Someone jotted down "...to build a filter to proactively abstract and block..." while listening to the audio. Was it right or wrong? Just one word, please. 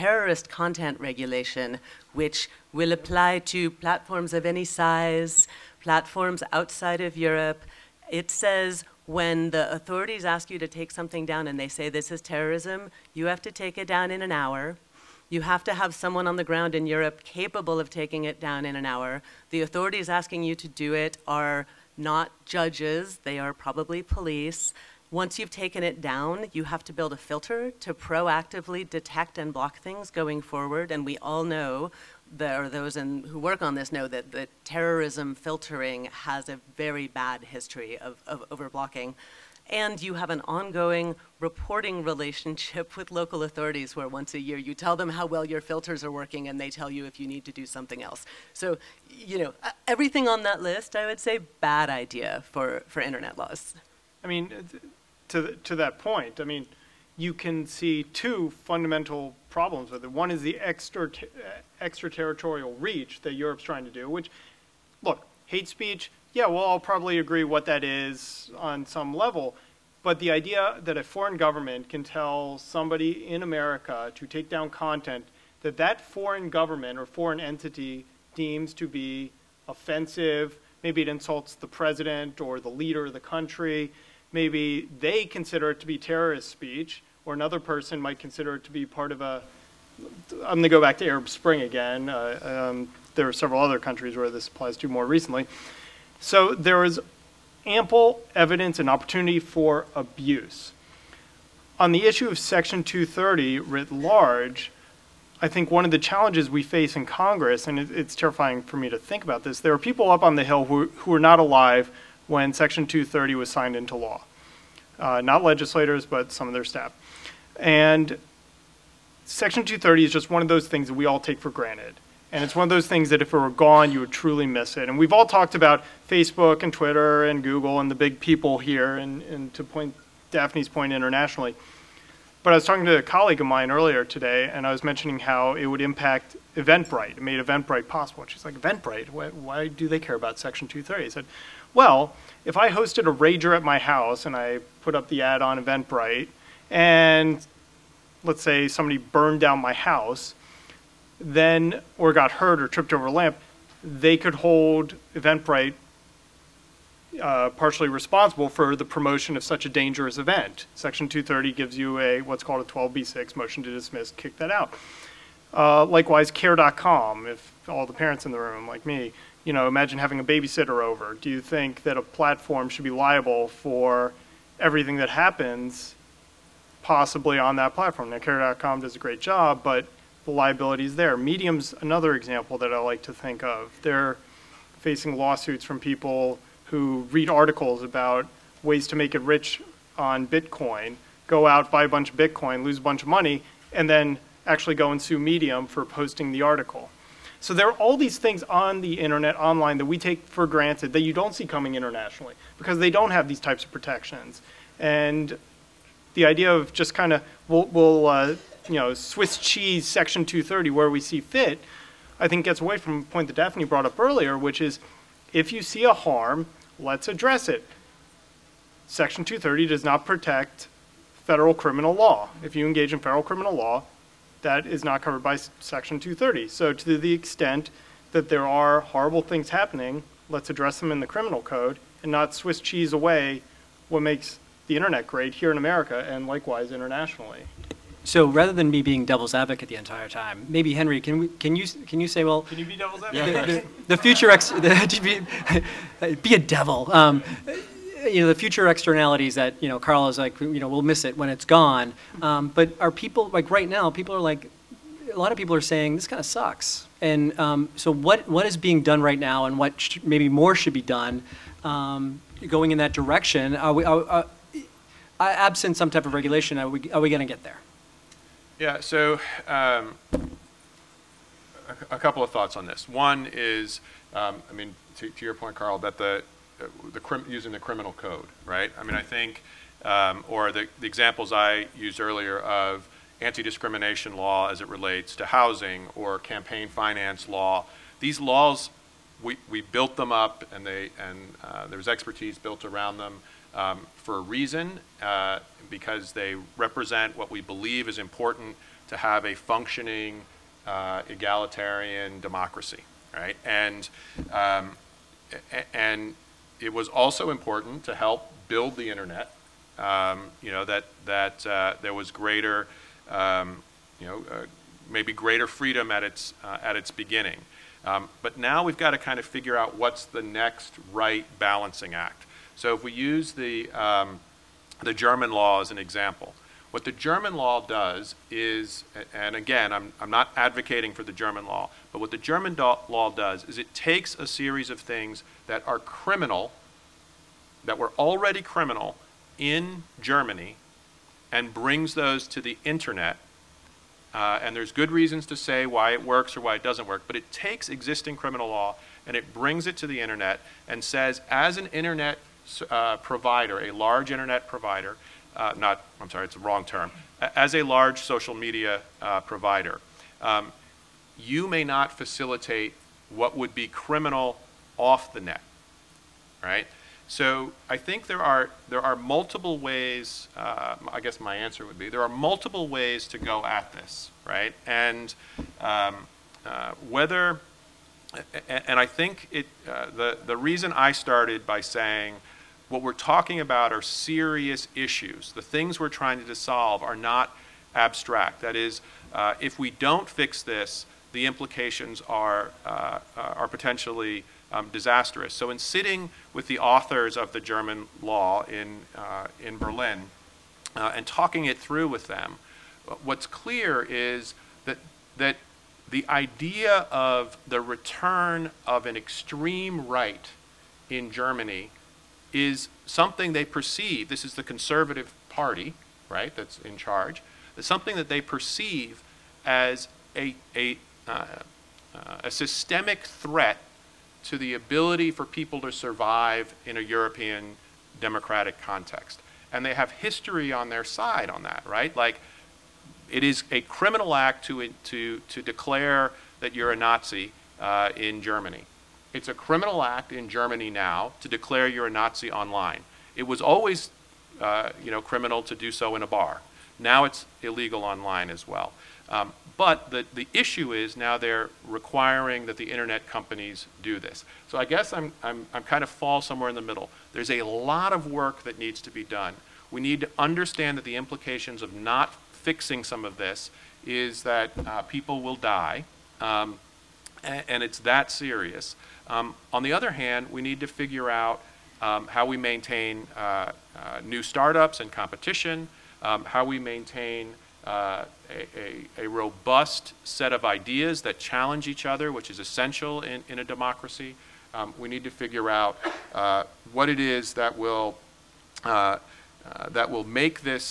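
wrong.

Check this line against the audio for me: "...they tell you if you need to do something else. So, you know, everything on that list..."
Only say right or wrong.
right.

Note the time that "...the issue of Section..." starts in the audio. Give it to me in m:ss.
1:41.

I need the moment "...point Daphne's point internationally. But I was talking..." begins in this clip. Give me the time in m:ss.
2:09.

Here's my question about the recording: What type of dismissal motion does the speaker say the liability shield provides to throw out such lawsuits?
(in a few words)
12b6 motion.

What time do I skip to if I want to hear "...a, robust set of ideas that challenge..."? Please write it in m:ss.
7:59.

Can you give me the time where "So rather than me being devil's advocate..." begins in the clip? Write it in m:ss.
3:58.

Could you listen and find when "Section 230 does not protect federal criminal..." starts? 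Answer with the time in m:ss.
3:38.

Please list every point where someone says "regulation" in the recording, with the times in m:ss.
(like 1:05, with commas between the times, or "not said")
0:01, 4:26.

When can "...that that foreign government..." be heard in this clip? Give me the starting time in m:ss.
1:15.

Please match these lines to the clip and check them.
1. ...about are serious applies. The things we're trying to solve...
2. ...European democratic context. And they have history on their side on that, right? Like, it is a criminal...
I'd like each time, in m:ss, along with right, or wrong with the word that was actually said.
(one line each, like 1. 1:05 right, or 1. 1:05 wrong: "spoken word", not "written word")
1. 6:23 wrong: "issues", not "applies"
2. 7:06 right.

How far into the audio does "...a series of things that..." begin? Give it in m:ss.
5:34.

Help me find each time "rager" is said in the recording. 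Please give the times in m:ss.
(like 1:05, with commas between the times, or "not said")
2:23.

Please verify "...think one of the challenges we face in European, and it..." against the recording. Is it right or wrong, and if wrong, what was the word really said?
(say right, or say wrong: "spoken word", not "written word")
wrong: "Congress", not "European".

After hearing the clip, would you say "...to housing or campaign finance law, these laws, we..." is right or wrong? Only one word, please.
right.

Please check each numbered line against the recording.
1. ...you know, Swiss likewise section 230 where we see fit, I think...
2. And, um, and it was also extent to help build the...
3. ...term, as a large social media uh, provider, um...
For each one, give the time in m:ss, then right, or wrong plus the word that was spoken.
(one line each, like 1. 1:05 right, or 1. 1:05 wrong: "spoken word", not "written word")
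1. 3:28 wrong: "cheese", not "likewise"
2. 5:03 wrong: "important", not "extent"
3. 5:56 right.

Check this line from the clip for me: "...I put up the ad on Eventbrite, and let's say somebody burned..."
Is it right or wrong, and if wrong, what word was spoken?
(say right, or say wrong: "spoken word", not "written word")
right.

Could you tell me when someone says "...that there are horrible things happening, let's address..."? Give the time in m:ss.
3:48.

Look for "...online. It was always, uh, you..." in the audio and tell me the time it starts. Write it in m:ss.
7:22.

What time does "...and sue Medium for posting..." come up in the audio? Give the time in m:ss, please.
3:14.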